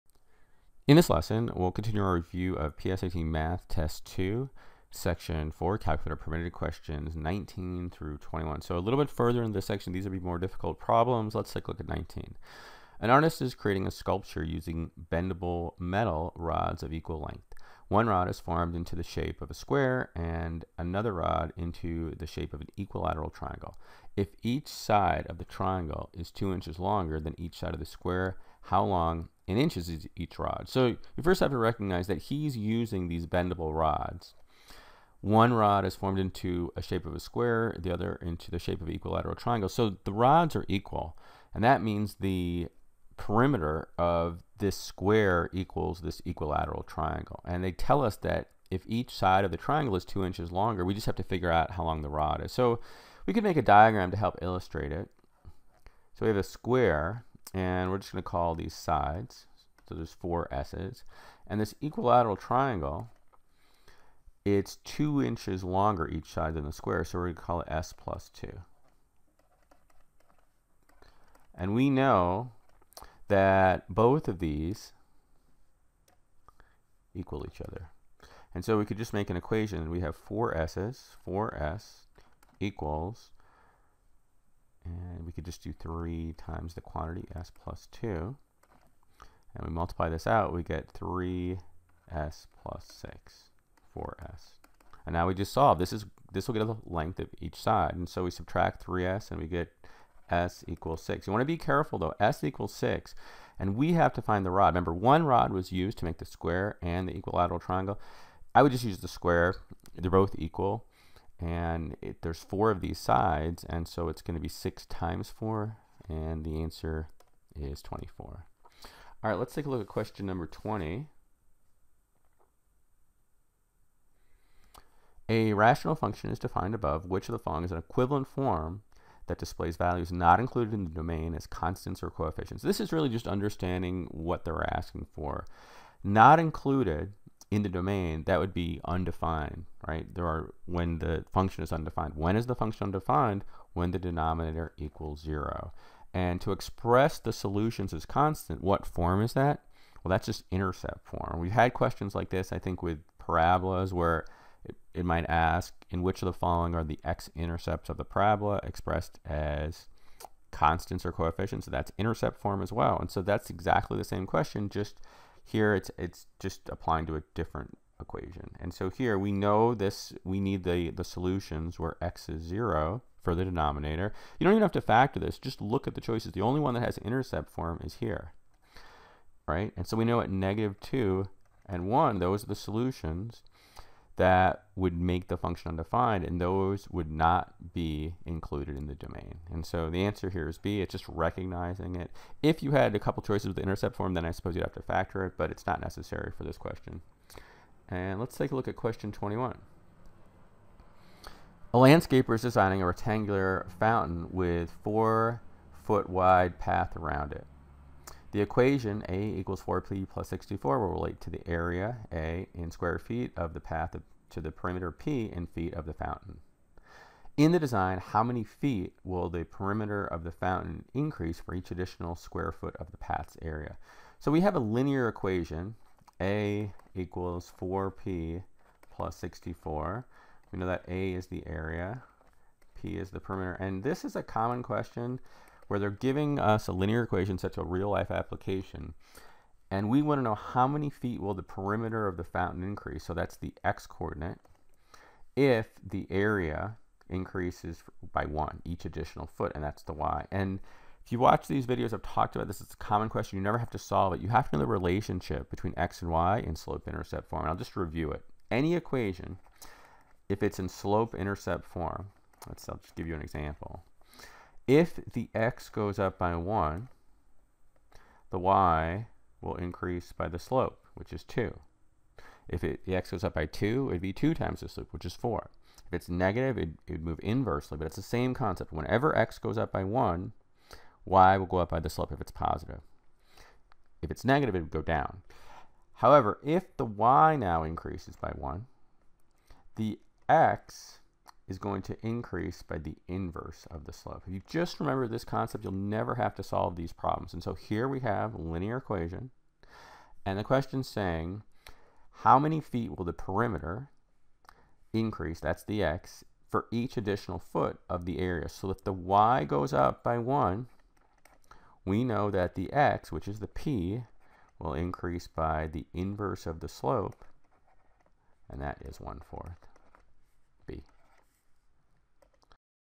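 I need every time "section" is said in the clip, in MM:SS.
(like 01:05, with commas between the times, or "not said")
00:04, 00:09.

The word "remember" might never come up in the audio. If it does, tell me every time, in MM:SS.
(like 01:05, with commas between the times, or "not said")
01:44, 04:54.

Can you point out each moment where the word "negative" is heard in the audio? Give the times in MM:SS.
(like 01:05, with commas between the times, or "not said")
03:00, 04:36, 04:44.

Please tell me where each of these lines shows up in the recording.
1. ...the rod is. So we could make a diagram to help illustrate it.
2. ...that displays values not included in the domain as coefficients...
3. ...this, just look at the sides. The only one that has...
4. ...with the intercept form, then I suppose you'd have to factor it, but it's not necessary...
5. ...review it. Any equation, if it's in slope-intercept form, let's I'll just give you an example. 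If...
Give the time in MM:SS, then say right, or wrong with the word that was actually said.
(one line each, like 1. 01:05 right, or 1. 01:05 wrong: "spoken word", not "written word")
1. 00:52 right
2. 02:09 wrong: "constants", not "coefficients"
3. 02:55 wrong: "choices", not "sides"
4. 03:13 right
5. 04:17 right.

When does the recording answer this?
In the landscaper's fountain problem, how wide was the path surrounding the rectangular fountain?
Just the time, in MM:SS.
03:24.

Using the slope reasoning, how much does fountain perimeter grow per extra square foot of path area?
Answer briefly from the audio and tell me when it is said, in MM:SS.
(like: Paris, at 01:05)
1/4, at 05:19.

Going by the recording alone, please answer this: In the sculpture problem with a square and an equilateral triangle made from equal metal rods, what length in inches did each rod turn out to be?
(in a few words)
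24.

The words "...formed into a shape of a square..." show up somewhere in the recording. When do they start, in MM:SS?
00:35.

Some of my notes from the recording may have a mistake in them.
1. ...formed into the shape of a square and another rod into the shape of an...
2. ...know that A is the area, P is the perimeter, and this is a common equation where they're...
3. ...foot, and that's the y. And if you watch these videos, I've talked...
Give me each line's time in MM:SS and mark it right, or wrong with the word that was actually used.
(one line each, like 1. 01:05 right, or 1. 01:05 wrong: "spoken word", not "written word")
1. 00:18 right
2. 03:50 wrong: "question", not "equation"
3. 04:09 right.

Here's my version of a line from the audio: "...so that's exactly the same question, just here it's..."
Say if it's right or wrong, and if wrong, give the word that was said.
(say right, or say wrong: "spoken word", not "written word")
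right.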